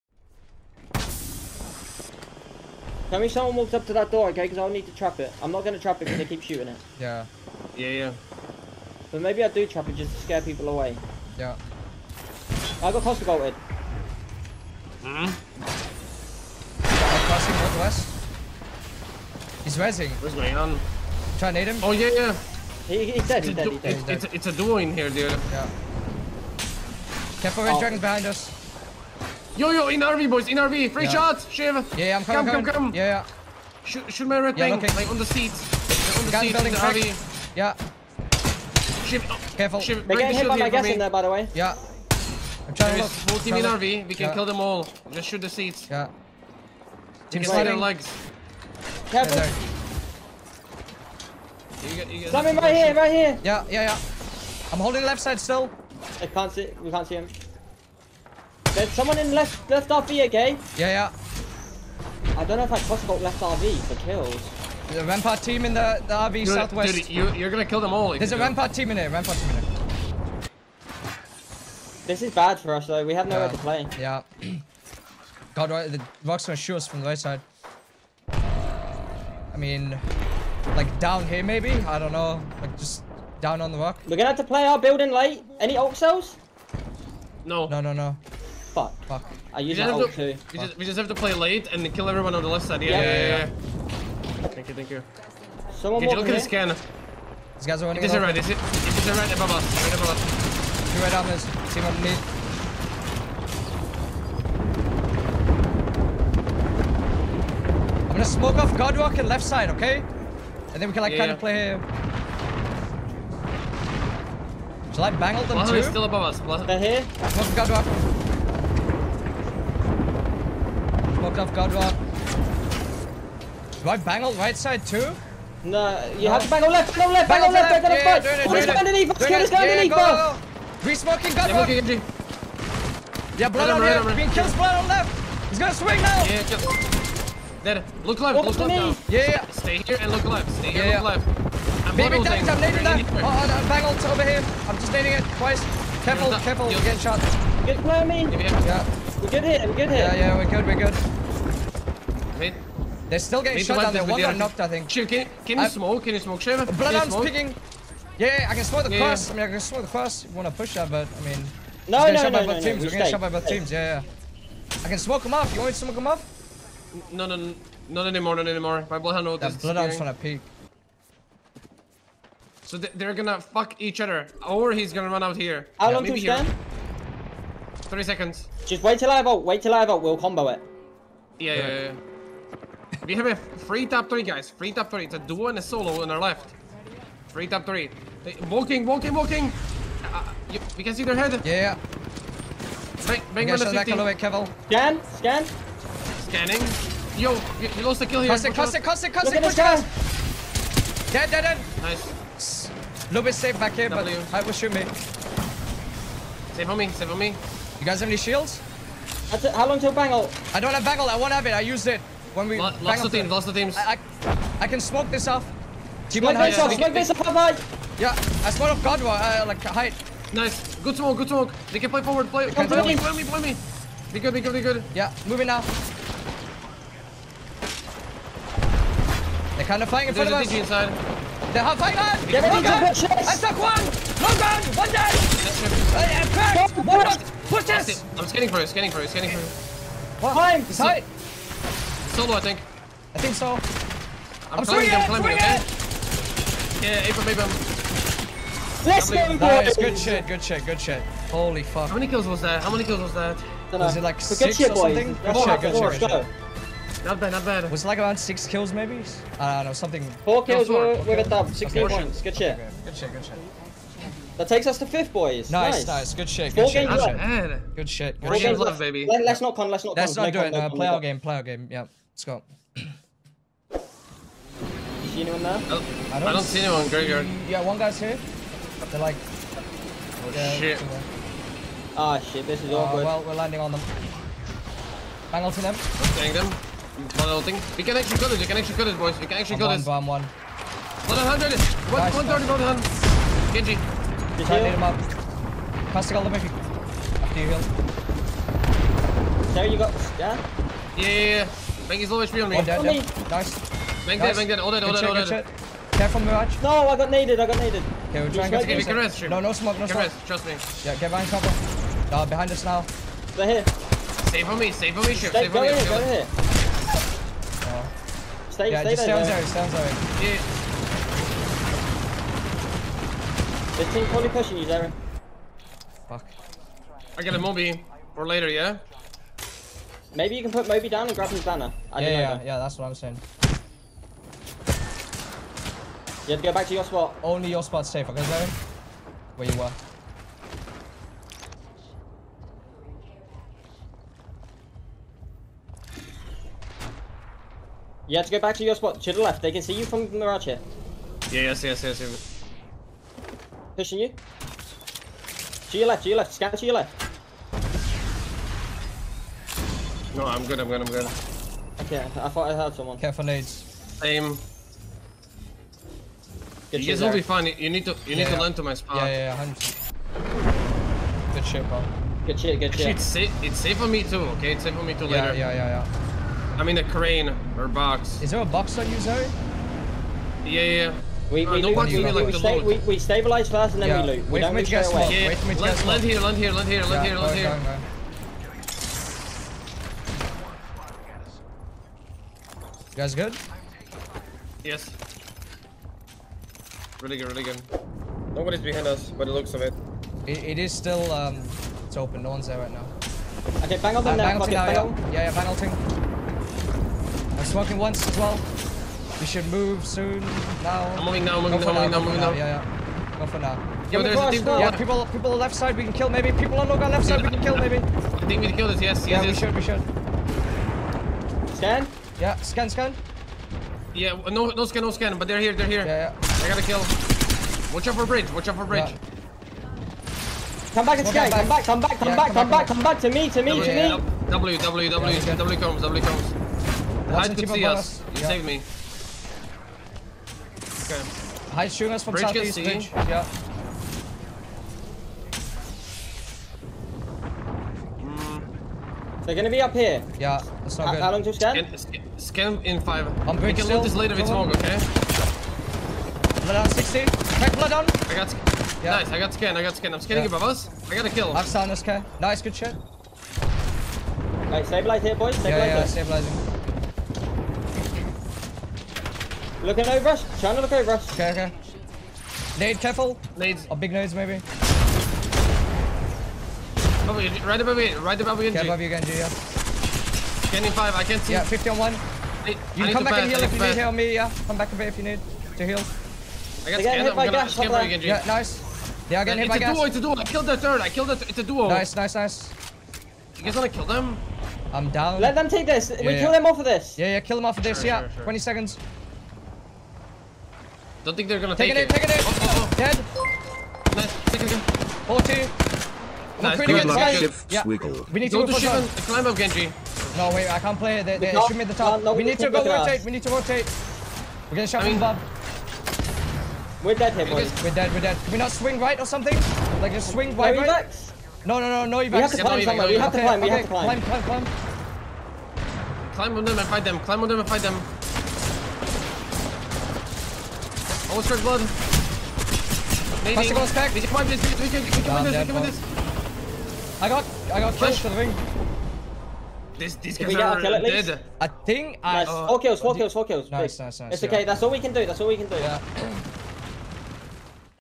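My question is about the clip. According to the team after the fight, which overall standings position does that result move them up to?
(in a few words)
fifth.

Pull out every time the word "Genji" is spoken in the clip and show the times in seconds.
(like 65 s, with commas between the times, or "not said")
293 s, 509 s.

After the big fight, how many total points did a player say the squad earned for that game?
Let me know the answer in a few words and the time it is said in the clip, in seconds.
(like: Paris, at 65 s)
16, at 261 s.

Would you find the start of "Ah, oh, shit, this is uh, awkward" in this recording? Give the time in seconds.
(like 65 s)
281 s.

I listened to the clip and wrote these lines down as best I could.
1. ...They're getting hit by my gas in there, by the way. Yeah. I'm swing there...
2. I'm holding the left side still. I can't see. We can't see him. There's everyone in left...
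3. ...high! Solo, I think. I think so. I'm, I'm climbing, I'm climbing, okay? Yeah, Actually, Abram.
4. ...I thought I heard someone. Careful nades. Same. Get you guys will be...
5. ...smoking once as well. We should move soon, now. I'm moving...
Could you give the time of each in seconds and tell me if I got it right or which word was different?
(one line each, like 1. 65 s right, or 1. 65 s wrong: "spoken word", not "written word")
1. 40 s wrong: "trying", not "swing"
2. 54 s wrong: "someone", not "everyone"
3. 240 s wrong: "Abram", not "Actually"
4. 362 s right
5. 407 s right.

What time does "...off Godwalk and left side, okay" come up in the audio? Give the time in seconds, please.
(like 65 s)
108 s.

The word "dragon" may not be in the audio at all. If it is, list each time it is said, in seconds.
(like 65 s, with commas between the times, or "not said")
27 s.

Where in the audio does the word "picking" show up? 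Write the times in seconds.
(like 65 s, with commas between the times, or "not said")
157 s.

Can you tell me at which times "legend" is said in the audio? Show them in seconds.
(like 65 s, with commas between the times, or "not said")
not said.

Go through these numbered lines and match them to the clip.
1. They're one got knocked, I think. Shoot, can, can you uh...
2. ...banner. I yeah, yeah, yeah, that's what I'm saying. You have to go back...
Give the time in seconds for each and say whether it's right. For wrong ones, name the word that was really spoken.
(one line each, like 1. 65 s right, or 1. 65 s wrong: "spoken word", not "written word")
1. 153 s right
2. 331 s right.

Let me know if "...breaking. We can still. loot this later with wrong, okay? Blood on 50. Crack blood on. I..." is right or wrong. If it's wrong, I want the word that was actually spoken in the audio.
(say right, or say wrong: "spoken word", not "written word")
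wrong: "60", not "50".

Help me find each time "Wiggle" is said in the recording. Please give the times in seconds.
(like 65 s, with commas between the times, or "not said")
507 s.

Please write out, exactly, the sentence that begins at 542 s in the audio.
Uh, four kills, four kills, four kills.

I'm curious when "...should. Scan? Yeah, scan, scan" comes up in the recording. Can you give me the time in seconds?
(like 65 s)
421 s.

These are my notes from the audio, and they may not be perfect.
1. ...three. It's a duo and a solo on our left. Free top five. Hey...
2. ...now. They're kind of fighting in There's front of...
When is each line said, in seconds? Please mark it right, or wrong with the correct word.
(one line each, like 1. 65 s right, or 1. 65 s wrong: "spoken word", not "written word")
1. 184 s wrong: "three", not "five"
2. 225 s right.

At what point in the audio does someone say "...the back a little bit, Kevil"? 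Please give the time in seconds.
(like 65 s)
193 s.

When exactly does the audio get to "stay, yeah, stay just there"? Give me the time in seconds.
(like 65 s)
318 s.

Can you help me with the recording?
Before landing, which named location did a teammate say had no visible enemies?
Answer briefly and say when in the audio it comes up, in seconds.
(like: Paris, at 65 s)
graveyard, at 276 s.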